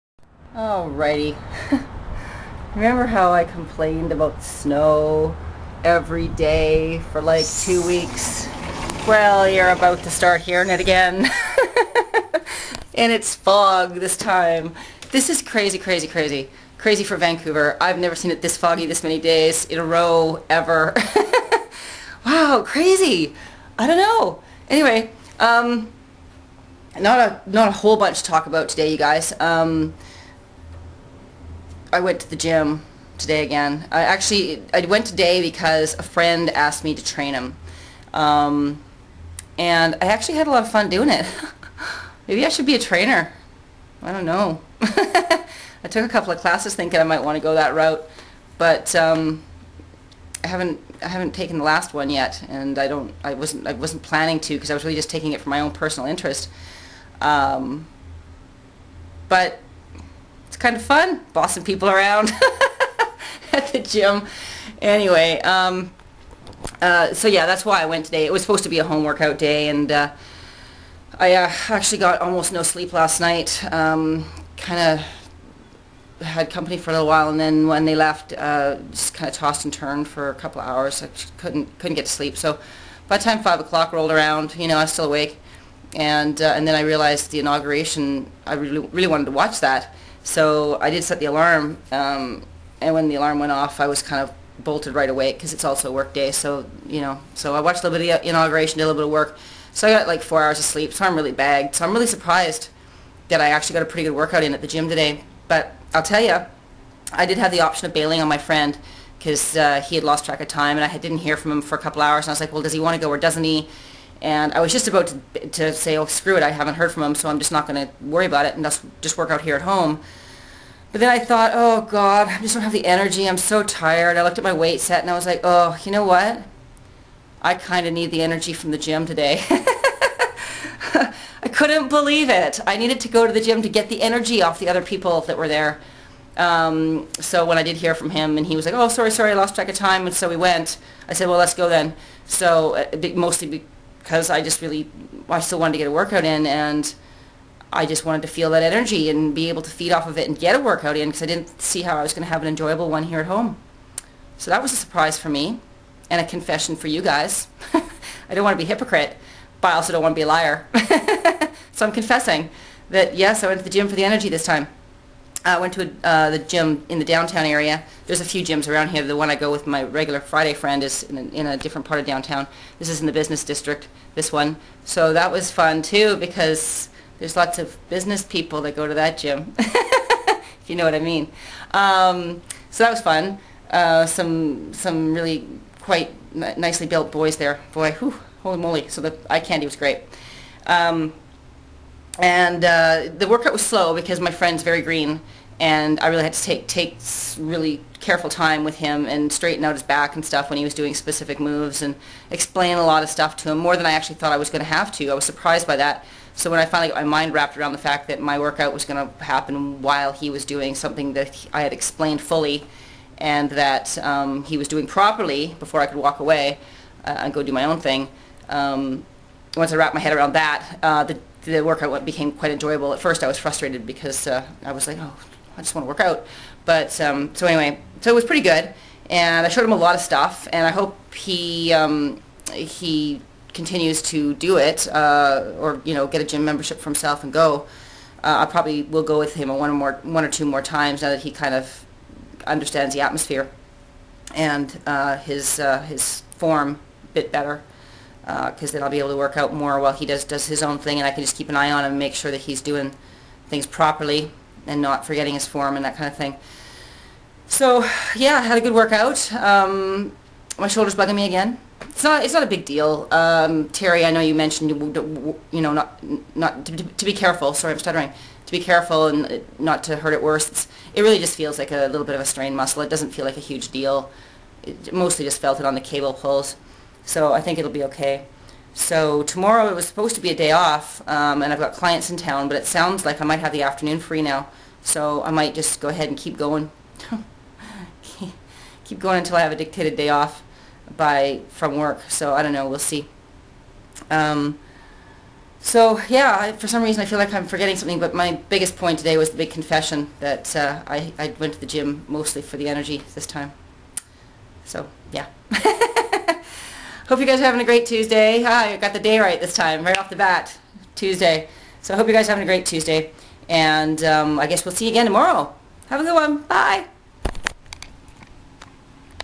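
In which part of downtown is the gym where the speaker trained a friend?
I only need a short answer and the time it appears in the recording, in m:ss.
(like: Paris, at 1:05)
Business district, at 2:53.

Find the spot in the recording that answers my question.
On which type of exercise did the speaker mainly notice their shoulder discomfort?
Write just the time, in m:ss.
4:35.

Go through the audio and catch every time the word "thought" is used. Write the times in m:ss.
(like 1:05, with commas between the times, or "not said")
2:01, 3:24.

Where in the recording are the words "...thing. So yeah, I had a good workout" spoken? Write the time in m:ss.
4:16.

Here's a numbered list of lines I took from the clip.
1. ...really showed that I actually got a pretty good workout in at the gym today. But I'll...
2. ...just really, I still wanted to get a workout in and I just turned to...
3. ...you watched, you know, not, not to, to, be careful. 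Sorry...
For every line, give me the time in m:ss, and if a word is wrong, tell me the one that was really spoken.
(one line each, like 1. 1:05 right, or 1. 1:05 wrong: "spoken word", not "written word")
1. 1:41 wrong: "surprised", not "showed"
2. 2:24 wrong: "wanted", not "turned"
3. 4:24 wrong: "mentioned", not "watched".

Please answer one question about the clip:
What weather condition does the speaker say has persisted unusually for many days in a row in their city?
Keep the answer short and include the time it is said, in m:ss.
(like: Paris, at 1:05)
Fog, at 0:13.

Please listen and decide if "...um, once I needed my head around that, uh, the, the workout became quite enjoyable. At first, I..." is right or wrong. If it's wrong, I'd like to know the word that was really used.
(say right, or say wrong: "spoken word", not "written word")
wrong: "wrapped", not "needed".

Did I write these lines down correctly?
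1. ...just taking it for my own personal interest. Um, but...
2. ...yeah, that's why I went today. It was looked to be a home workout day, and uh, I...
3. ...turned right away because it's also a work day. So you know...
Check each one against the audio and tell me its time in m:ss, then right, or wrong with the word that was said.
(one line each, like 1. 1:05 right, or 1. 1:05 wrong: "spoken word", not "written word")
1. 0:54 right
2. 1:07 wrong: "supposed", not "looked"
3. 1:34 wrong: "bolted", not "turned".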